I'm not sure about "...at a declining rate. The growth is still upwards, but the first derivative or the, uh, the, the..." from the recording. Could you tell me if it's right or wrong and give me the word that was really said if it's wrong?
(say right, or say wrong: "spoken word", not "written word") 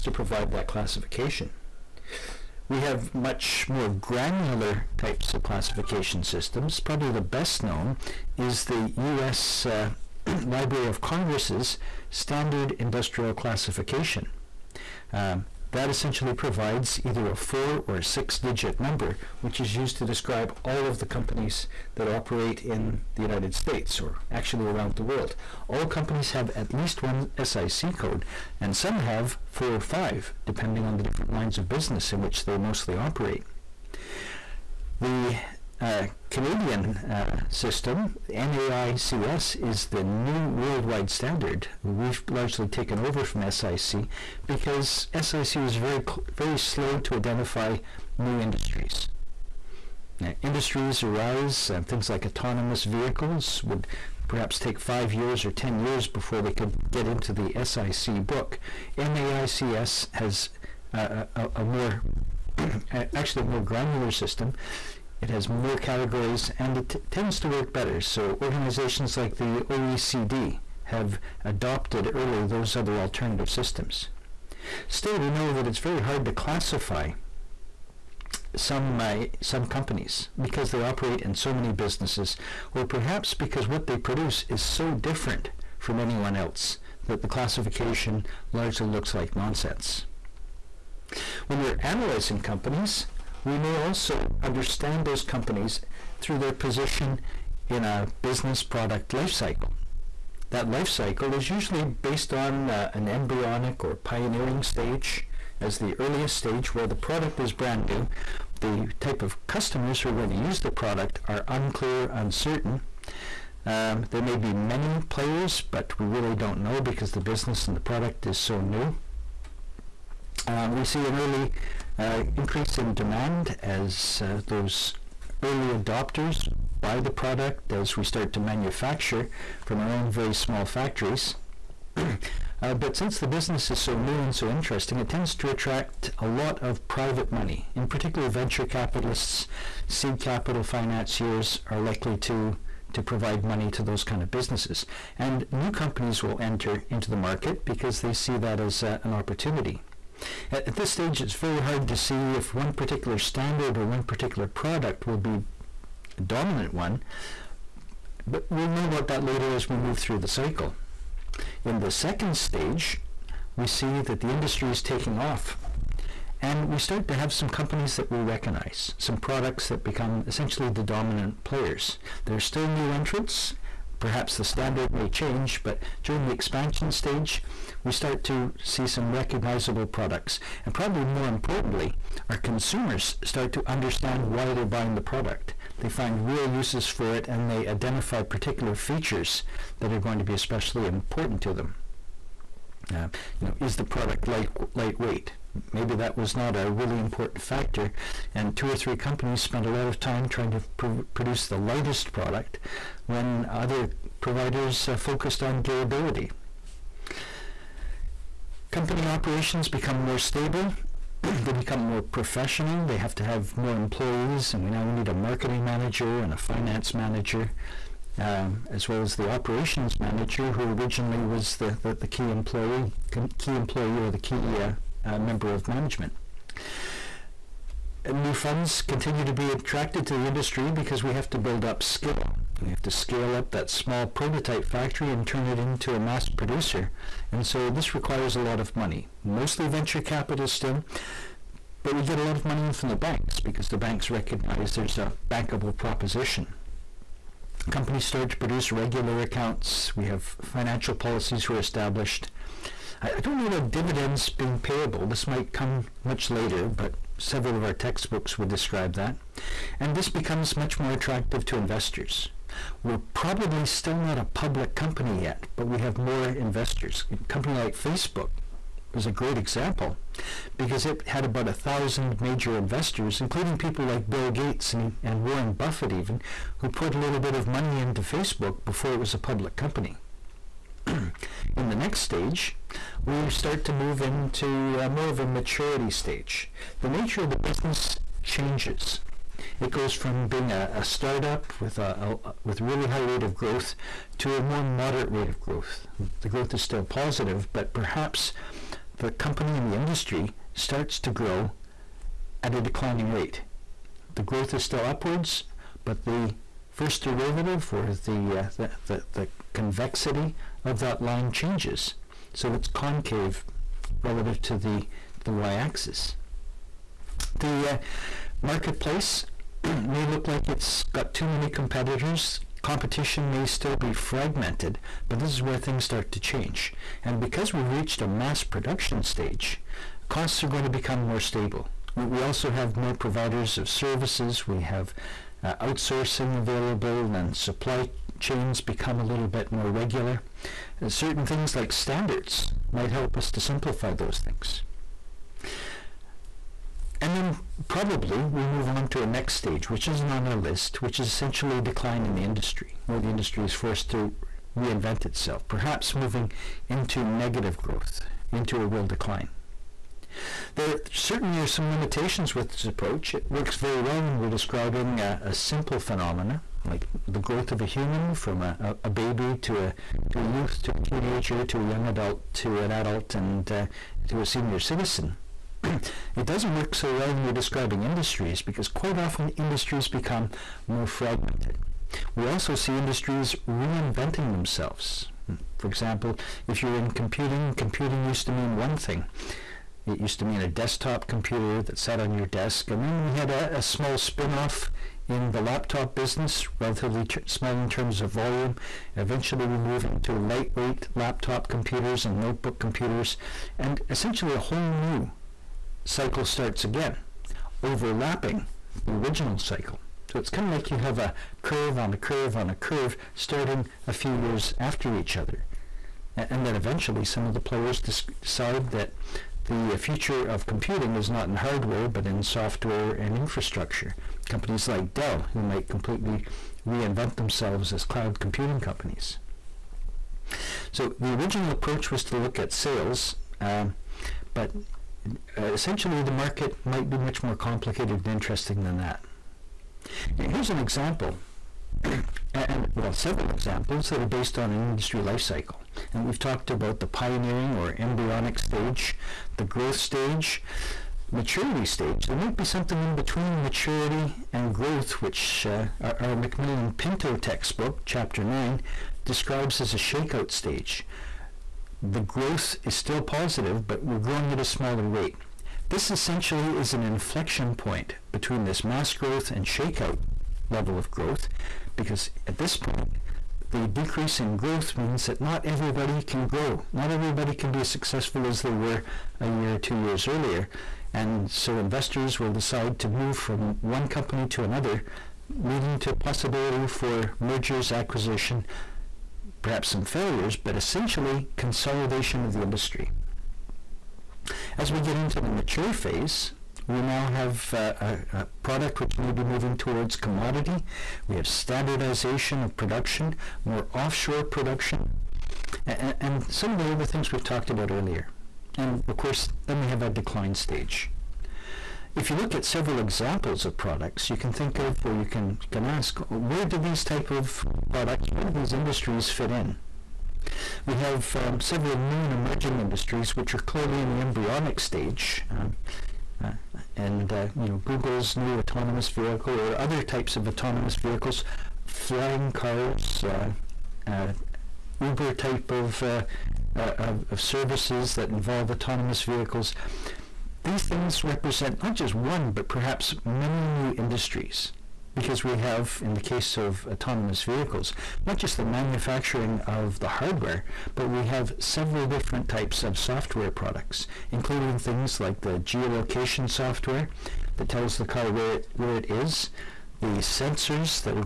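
right.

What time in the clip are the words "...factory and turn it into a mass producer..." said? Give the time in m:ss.
3:54.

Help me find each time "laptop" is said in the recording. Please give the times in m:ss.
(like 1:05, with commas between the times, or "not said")
6:35, 6:40.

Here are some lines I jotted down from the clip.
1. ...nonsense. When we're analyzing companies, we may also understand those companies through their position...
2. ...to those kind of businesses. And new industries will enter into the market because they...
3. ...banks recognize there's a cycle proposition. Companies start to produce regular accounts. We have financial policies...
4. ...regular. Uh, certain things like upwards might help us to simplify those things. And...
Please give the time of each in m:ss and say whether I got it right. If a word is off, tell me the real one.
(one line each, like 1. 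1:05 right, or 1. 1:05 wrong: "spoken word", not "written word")
1. 1:29 right
2. 2:23 wrong: "companies", not "industries"
3. 4:03 wrong: "bankable", not "cycle"
4. 5:39 wrong: "standards", not "upwards".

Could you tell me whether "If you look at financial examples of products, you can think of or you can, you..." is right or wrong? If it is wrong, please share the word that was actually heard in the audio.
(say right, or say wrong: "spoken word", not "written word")
wrong: "several", not "financial".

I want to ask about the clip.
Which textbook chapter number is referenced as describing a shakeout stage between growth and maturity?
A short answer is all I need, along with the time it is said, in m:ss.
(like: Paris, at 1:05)
9, at 7:37.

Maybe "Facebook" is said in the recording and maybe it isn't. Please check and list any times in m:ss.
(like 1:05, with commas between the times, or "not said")
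4:27, 4:38.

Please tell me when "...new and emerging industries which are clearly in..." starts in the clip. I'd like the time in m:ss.
8:41.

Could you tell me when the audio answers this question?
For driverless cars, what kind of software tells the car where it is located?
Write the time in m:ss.
9:15.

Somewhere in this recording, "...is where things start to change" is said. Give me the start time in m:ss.
5:25.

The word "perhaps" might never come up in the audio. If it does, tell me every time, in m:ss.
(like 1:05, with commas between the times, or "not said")
0:54, 1:22, 2:54, 4:57, 5:55, 8:09, 9:02.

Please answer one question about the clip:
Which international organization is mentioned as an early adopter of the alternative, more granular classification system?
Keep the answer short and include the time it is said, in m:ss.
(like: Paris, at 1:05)
OECD, at 1:09.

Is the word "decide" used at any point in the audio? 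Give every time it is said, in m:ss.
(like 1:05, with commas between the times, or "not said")
6:57, 8:02.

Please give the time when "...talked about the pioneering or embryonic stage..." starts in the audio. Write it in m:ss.
7:26.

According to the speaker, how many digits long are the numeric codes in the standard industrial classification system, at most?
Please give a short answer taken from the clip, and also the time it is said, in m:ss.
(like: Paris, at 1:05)
6, at 0:18.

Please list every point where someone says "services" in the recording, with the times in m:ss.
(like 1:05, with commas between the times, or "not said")
5:33, 8:57.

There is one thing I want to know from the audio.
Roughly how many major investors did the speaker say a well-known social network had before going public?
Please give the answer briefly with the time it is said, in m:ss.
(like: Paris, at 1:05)
1000, at 4:31.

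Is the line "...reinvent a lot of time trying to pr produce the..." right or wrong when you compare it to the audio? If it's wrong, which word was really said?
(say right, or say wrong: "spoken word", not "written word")
wrong: "spent", not "reinvent".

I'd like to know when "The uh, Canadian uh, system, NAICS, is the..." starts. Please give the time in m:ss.
0:35.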